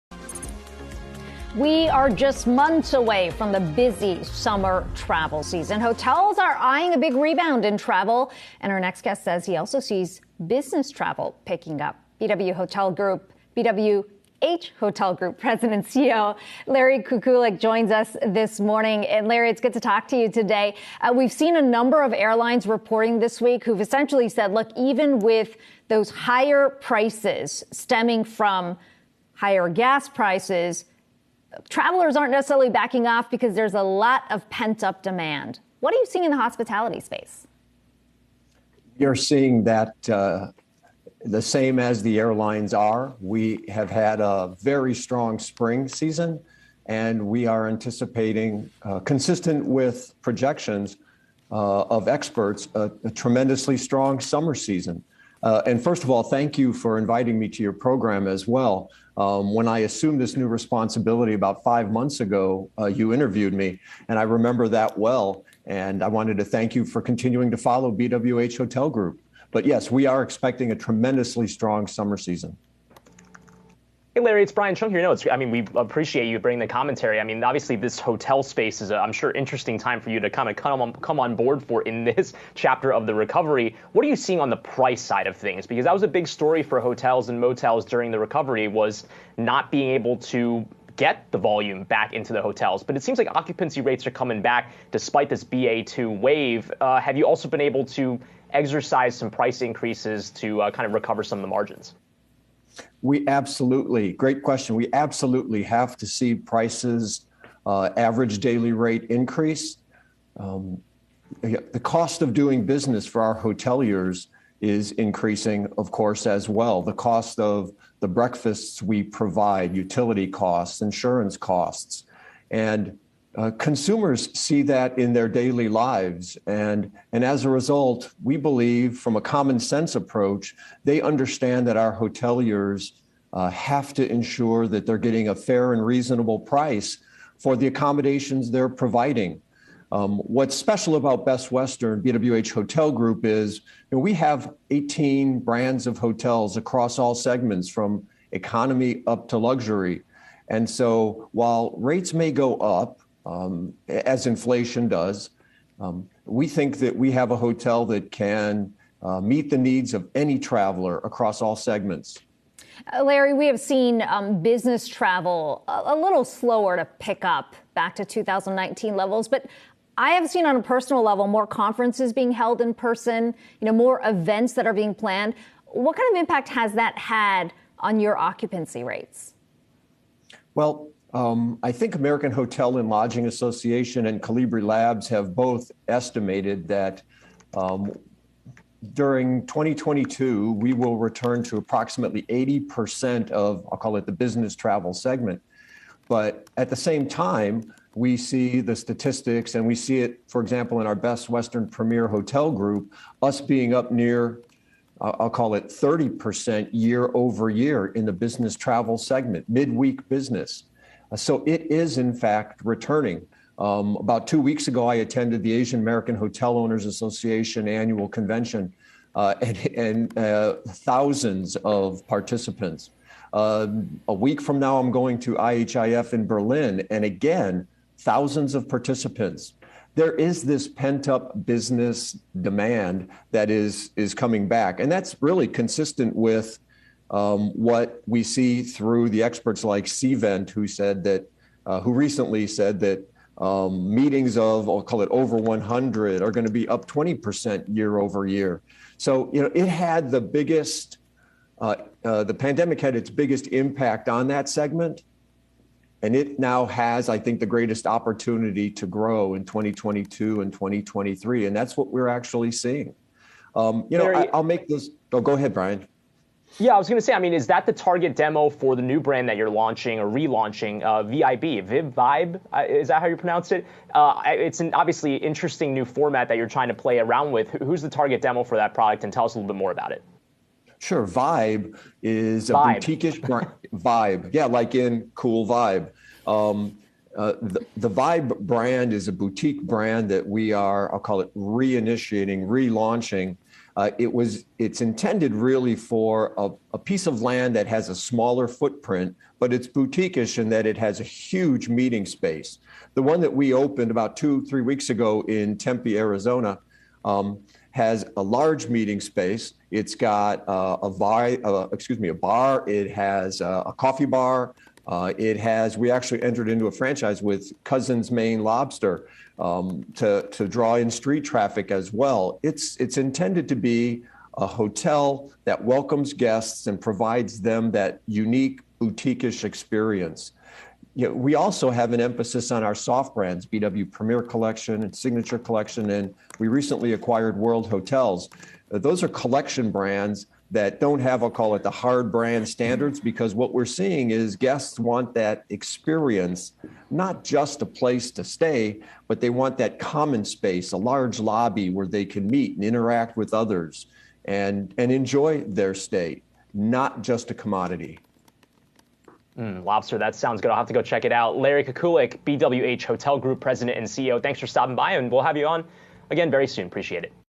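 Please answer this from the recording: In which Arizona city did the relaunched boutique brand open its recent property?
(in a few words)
Tempe.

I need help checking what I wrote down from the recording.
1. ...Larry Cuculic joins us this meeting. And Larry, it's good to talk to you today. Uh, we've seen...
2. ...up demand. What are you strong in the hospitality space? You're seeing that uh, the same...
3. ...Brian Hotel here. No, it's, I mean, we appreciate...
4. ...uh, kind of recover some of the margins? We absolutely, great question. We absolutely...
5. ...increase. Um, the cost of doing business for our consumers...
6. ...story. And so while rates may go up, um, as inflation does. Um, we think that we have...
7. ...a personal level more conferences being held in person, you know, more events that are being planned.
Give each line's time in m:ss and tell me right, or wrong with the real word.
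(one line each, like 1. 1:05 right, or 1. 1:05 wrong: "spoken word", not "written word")
1. 0:16 wrong: "morning", not "meeting"
2. 0:34 wrong: "seeing", not "strong"
3. 1:14 wrong: "Cheung", not "Hotel"
4. 1:40 right
5. 1:49 wrong: "hoteliers", not "consumers"
6. 2:29 wrong: "luxury", not "story"
7. 2:50 right.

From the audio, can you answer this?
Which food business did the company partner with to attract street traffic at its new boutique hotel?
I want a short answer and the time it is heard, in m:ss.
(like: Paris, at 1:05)
Cousins Maine Lobster, at 5:17.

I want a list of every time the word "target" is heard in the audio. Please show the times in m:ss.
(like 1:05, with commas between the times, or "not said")
4:27, 4:37.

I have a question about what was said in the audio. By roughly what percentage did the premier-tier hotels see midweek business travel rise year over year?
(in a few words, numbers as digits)
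30%.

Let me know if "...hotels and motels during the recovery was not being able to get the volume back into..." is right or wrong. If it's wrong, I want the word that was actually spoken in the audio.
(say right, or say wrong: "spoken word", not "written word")
right.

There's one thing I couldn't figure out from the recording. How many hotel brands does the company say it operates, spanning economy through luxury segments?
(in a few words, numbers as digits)
18.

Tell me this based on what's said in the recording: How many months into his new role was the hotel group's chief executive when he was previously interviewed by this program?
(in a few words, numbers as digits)
5.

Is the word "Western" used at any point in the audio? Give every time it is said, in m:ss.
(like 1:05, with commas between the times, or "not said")
2:21, 3:21.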